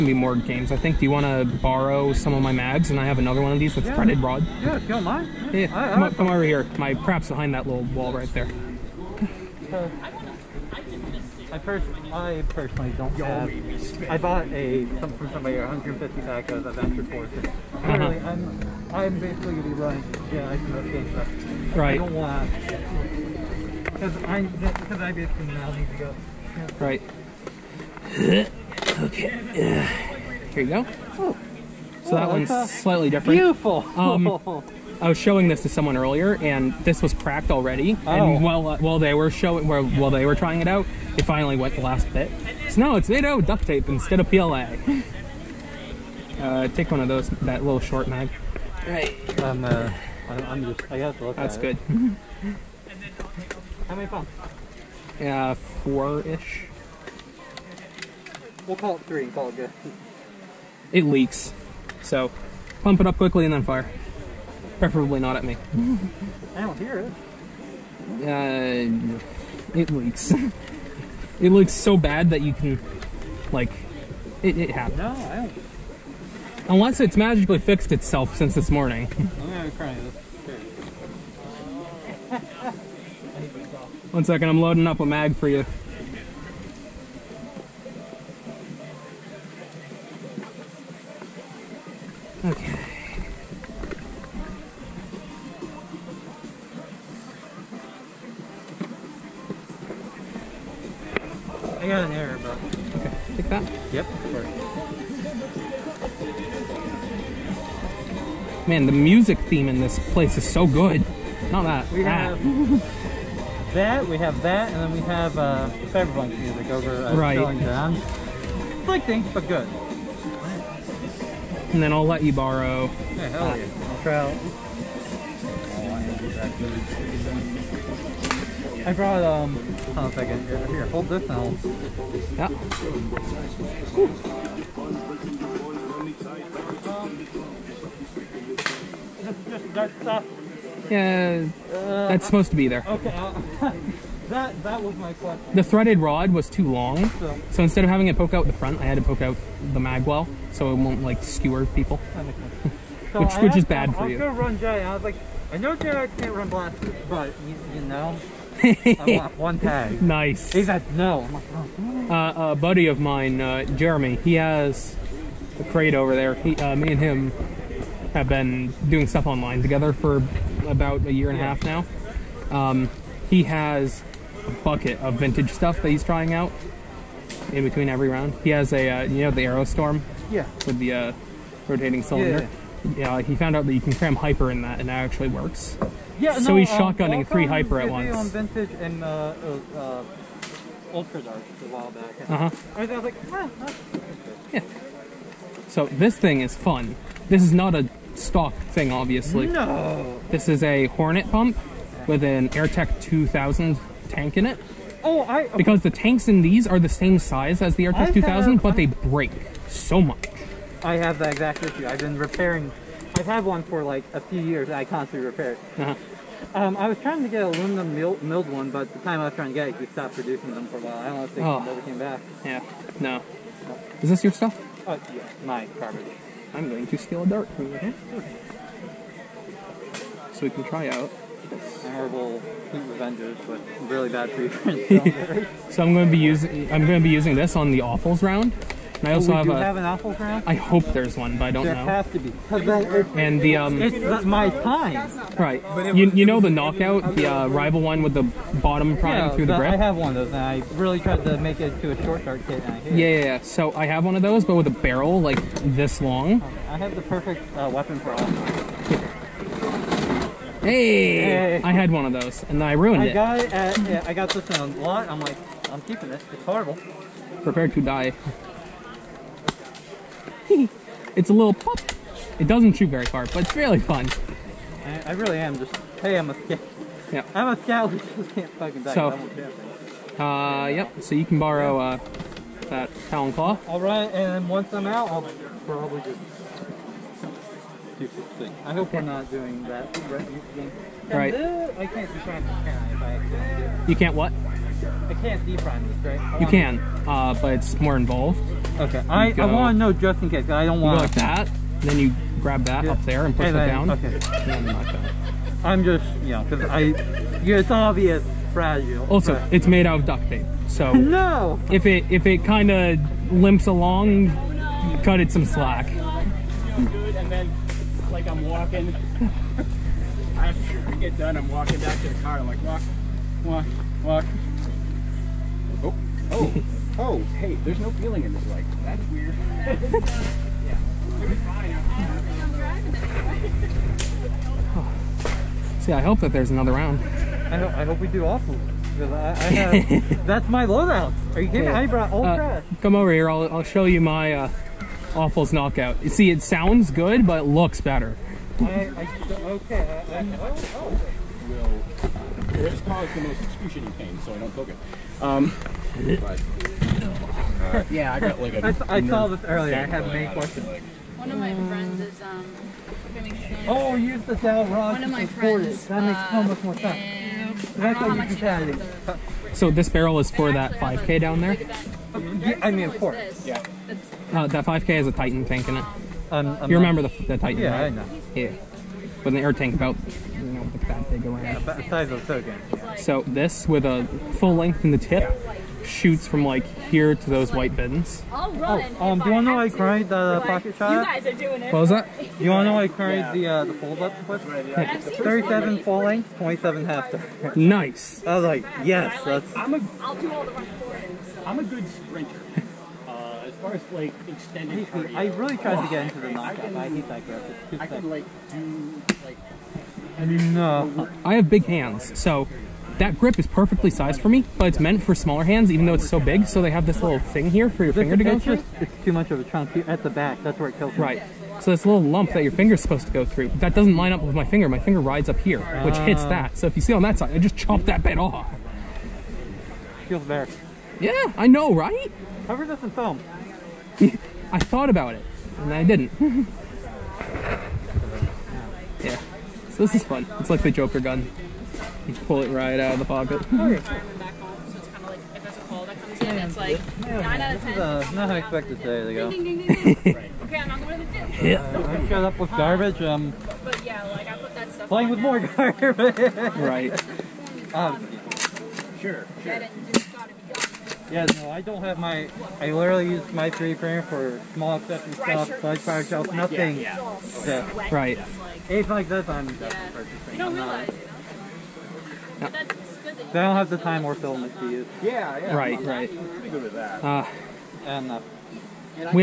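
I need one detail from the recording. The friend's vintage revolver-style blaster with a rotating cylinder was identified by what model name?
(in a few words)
Aerostorm.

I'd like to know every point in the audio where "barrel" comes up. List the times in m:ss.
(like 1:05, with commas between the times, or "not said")
4:14, 6:09.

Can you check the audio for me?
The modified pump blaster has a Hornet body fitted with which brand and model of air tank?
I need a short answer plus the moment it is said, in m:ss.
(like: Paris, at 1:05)
AirTech 2000, at 3:22.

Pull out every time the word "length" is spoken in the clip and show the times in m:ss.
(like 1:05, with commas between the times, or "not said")
6:24, 6:35.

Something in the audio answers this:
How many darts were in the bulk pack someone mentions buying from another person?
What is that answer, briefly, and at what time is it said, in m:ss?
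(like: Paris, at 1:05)
150, at 0:15.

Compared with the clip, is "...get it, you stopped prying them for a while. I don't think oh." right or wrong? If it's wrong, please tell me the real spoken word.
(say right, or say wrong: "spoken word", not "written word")
wrong: "producing", not "prying".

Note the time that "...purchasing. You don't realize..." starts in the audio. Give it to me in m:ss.
7:50.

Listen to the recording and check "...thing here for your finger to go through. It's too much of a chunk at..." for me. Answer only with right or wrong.
right.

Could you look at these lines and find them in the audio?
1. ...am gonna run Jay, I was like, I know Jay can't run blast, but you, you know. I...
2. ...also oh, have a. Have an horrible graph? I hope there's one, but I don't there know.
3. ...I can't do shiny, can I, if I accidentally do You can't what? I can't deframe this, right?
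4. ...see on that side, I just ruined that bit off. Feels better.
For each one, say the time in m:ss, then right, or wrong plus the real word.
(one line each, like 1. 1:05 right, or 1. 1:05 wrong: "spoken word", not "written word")
1. 2:34 right
2. 3:59 wrong: "apple", not "horrible"
3. 4:51 right
4. 7:06 wrong: "chopped", not "ruined".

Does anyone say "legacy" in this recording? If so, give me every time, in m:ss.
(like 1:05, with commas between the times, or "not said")
not said.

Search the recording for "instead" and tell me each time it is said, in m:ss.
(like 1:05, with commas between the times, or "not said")
0:43, 2:27.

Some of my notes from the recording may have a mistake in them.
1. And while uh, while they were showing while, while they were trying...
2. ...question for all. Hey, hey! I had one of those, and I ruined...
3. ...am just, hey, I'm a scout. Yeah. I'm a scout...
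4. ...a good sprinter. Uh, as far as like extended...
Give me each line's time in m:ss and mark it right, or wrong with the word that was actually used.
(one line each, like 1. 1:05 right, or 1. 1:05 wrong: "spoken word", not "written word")
1. 0:38 right
2. 4:17 wrong: "weapon", not "question"
3. 4:35 right
4. 6:41 right.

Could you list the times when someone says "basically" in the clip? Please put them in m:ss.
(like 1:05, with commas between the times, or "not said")
0:19, 0:25.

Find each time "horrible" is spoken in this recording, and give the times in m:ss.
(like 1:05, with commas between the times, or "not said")
4:26.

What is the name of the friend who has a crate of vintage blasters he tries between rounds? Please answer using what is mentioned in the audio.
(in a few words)
Jeremy.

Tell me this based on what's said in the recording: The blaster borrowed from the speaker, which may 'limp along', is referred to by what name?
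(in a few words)
Talon Claw.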